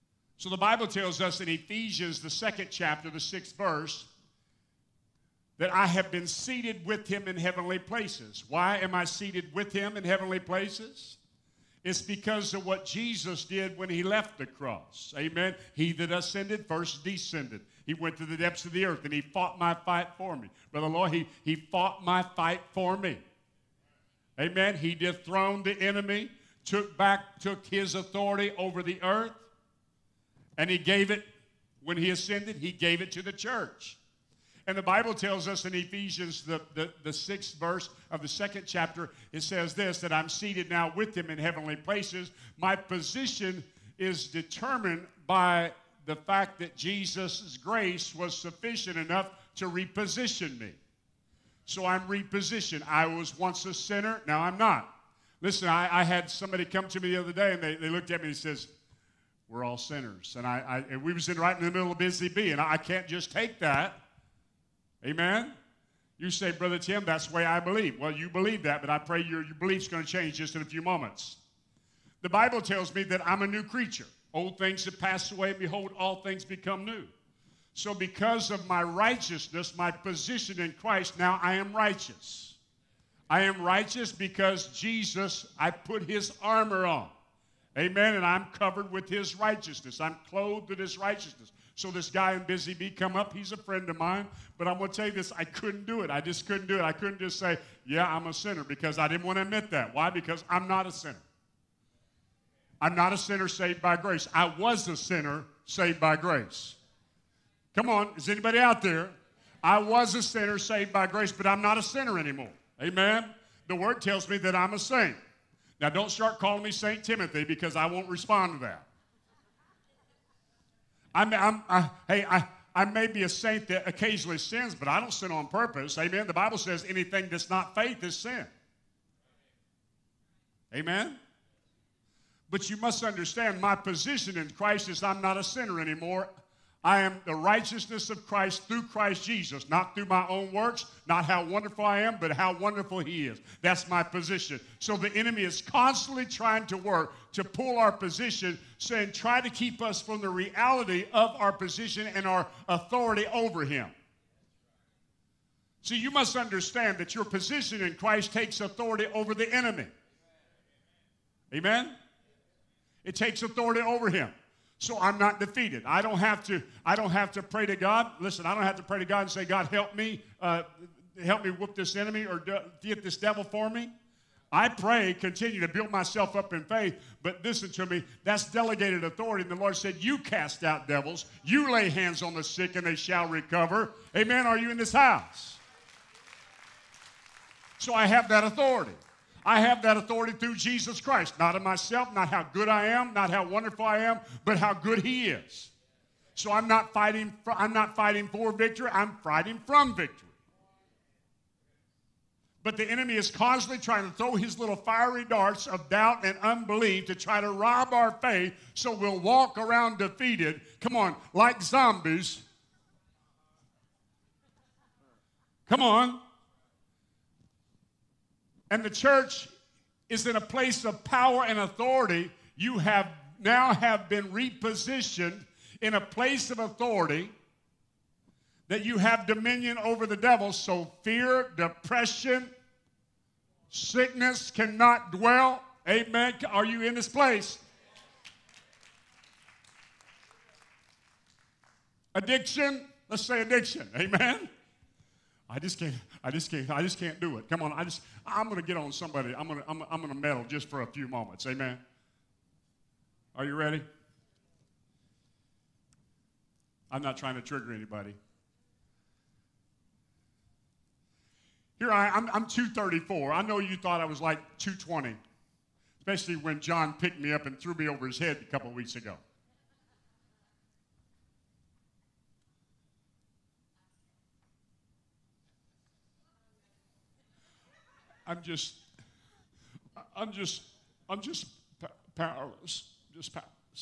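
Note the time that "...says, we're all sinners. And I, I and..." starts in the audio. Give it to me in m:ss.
0:58.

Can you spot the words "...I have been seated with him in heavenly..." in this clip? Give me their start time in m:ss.
0:05.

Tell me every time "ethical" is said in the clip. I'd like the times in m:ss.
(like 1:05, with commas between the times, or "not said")
not said.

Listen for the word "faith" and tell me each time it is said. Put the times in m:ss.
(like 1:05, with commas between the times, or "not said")
2:07, 2:56, 3:28.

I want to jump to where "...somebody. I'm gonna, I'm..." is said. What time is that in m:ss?
4:08.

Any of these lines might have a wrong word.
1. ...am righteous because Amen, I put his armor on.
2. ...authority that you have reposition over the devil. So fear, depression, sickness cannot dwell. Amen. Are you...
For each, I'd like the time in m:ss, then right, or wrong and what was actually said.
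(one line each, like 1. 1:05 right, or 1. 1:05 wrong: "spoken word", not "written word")
1. 1:23 wrong: "Jesus", not "Amen"
2. 3:46 wrong: "dominion", not "reposition".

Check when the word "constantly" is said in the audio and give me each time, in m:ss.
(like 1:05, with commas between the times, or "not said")
2:25, 3:23.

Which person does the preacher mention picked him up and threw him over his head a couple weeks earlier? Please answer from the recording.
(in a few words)
John.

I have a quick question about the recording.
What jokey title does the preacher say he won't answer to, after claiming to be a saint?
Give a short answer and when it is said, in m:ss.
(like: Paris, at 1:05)
St. Timothy, at 1:56.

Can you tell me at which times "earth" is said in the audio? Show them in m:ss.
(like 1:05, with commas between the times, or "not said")
0:18, 0:29.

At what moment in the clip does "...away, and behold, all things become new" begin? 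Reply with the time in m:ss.
1:15.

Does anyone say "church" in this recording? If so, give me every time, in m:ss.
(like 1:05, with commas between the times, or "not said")
0:33, 3:38.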